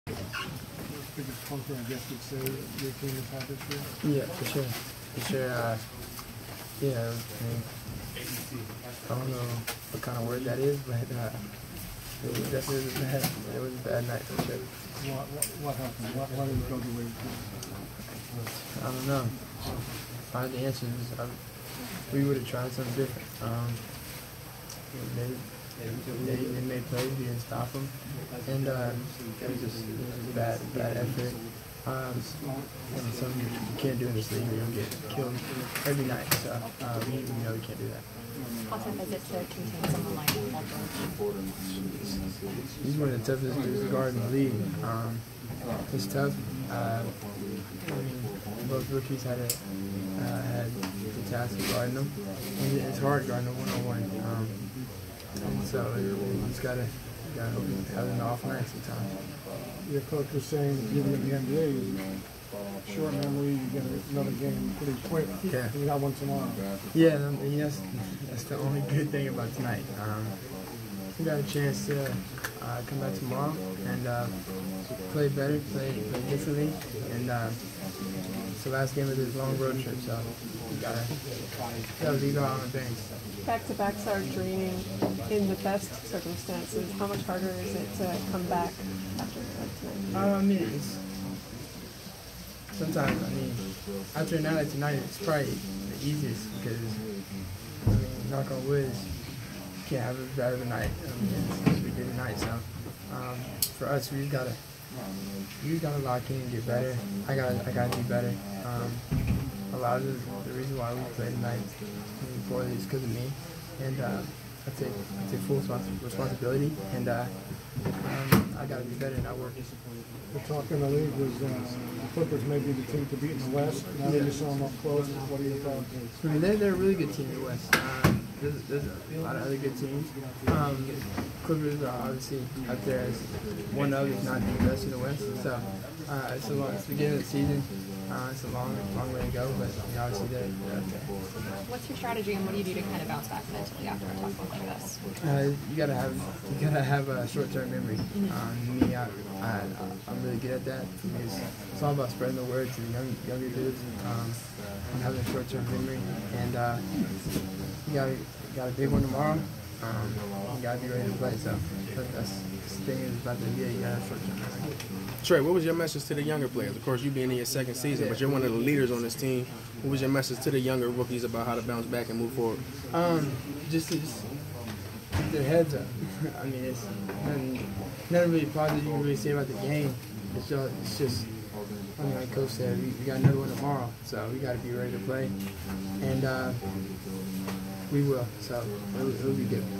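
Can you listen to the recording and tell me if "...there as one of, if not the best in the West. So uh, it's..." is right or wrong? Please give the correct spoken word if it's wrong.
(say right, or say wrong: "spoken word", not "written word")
right.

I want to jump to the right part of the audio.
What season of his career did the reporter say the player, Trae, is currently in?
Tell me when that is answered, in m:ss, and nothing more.
2:47.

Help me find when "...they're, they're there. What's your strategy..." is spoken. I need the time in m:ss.
2:20.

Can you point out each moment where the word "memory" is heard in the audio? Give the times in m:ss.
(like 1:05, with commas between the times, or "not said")
1:03, 2:27, 2:35.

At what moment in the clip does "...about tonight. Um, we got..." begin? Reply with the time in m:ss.
1:09.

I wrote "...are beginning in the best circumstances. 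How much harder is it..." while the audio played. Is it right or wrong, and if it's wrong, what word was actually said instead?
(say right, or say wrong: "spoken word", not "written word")
wrong: "draining", not "beginning".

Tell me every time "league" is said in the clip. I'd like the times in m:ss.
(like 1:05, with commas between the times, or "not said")
0:34, 0:44, 2:00.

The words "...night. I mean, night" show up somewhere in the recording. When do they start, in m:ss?
1:40.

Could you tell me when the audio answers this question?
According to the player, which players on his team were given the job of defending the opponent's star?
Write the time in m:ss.
0:48.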